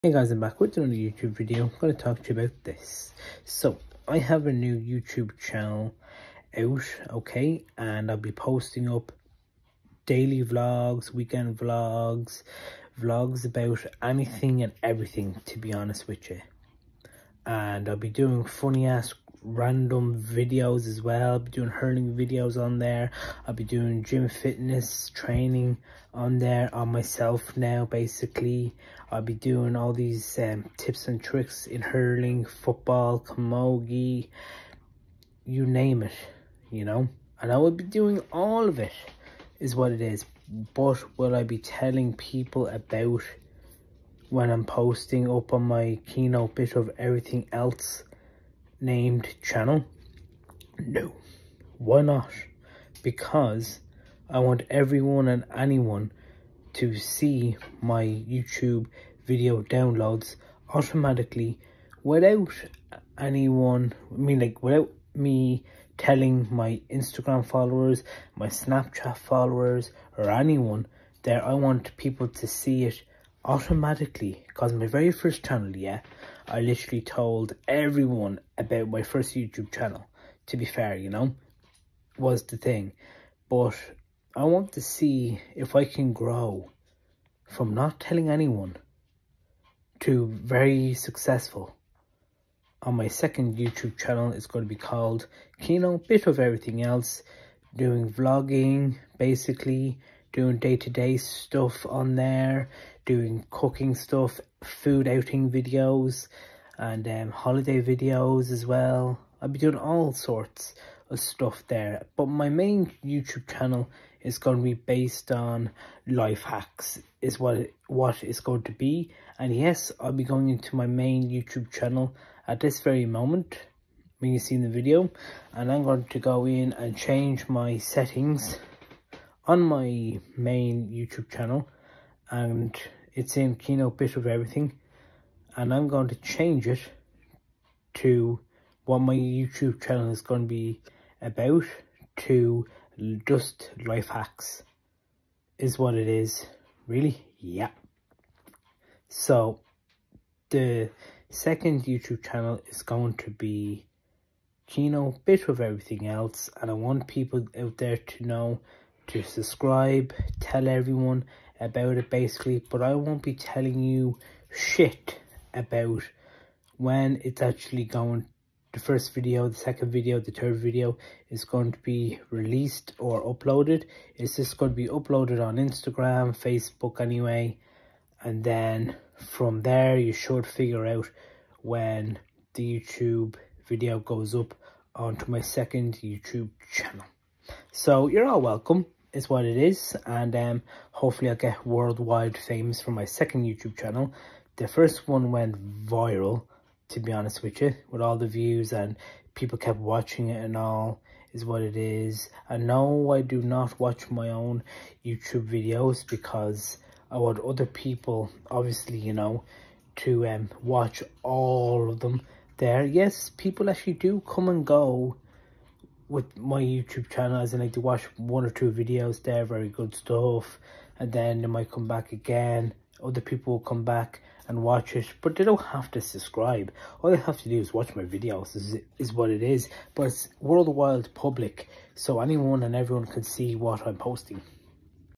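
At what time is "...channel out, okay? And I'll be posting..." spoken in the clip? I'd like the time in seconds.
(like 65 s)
5 s.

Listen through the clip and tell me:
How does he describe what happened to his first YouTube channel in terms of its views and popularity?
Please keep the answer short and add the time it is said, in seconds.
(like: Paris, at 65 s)
went viral, at 195 s.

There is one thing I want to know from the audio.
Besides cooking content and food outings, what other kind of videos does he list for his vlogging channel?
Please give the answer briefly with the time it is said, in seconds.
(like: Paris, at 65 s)
holiday videos, at 107 s.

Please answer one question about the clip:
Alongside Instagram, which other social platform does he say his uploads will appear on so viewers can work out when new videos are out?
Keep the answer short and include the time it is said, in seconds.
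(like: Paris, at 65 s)
Facebook, at 176 s.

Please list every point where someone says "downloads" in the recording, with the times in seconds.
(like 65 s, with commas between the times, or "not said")
59 s.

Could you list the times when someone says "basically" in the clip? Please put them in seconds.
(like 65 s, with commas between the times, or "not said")
27 s, 99 s, 162 s.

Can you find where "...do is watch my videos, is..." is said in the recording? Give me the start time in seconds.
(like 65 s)
227 s.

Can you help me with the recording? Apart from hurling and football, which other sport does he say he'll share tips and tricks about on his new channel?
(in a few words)
camogie.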